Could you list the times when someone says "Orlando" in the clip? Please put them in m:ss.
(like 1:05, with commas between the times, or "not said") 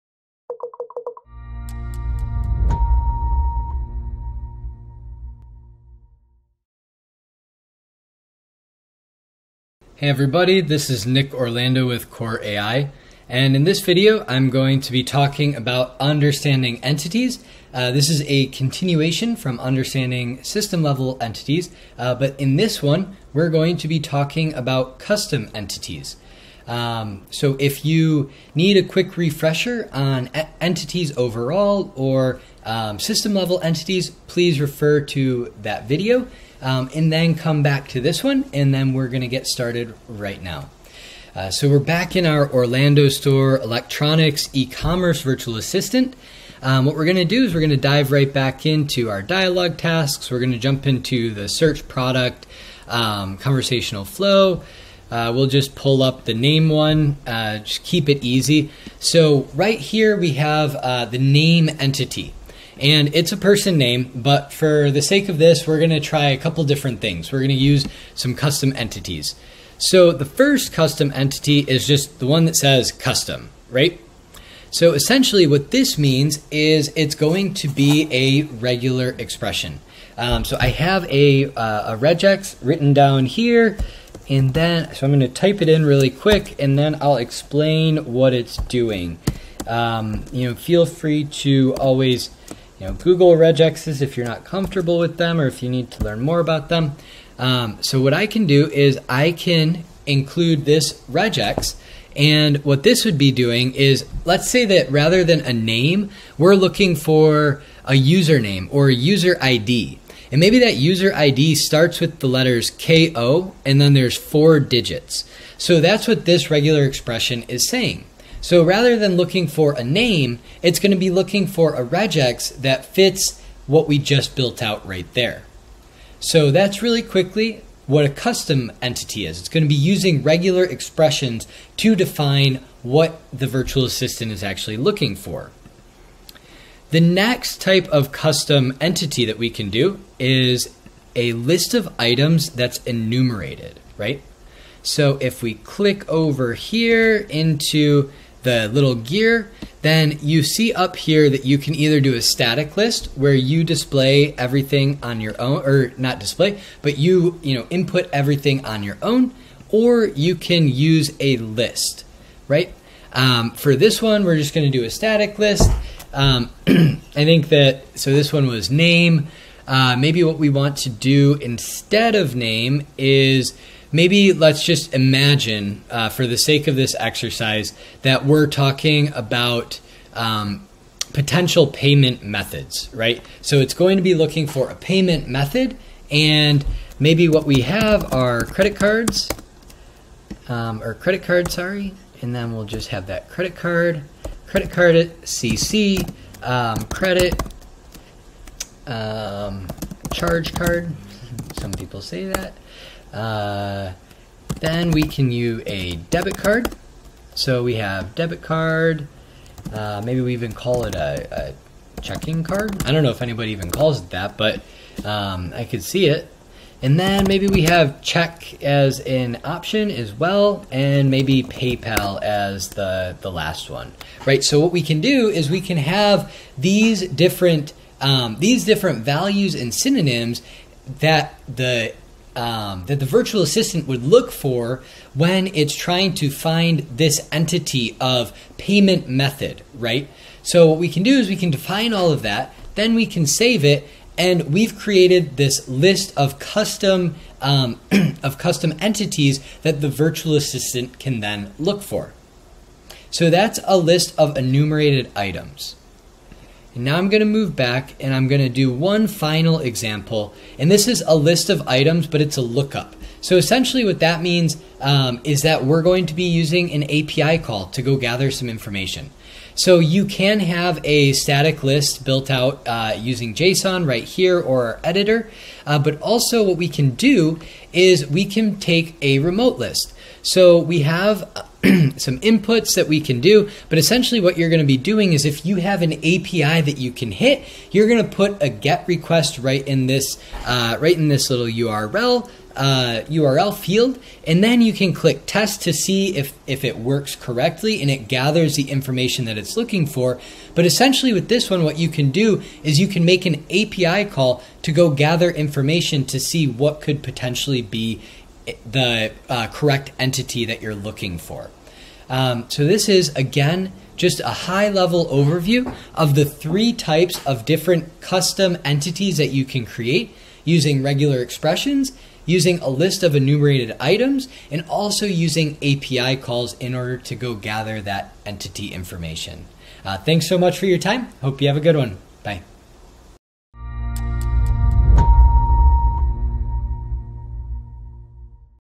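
0:11, 0:42.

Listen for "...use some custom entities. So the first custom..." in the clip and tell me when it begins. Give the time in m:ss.
1:07.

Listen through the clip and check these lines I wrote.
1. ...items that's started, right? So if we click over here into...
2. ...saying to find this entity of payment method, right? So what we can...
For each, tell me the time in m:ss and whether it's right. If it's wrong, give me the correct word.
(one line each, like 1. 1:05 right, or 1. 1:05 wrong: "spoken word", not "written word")
1. 2:21 wrong: "enumerated", not "started"
2. 3:55 wrong: "trying", not "saying".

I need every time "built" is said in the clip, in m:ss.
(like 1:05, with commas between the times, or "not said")
2:04, 4:32.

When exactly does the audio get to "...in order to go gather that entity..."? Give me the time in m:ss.
5:26.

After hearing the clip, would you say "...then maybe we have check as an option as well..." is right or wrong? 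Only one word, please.
right.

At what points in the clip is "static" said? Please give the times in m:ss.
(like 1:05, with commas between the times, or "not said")
2:32, 2:44, 4:31.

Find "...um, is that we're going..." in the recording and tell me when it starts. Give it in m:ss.
4:24.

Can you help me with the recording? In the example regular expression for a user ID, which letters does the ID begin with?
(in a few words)
KO.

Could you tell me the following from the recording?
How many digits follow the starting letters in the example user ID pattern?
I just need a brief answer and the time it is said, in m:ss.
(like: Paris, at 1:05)
4, at 1:54.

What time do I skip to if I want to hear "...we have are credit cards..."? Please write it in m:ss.
3:07.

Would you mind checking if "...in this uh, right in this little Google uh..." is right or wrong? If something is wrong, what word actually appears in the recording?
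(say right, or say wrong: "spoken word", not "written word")
wrong: "URL", not "Google".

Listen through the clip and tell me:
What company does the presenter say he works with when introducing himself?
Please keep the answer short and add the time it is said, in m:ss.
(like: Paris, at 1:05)
Kore.ai, at 0:12.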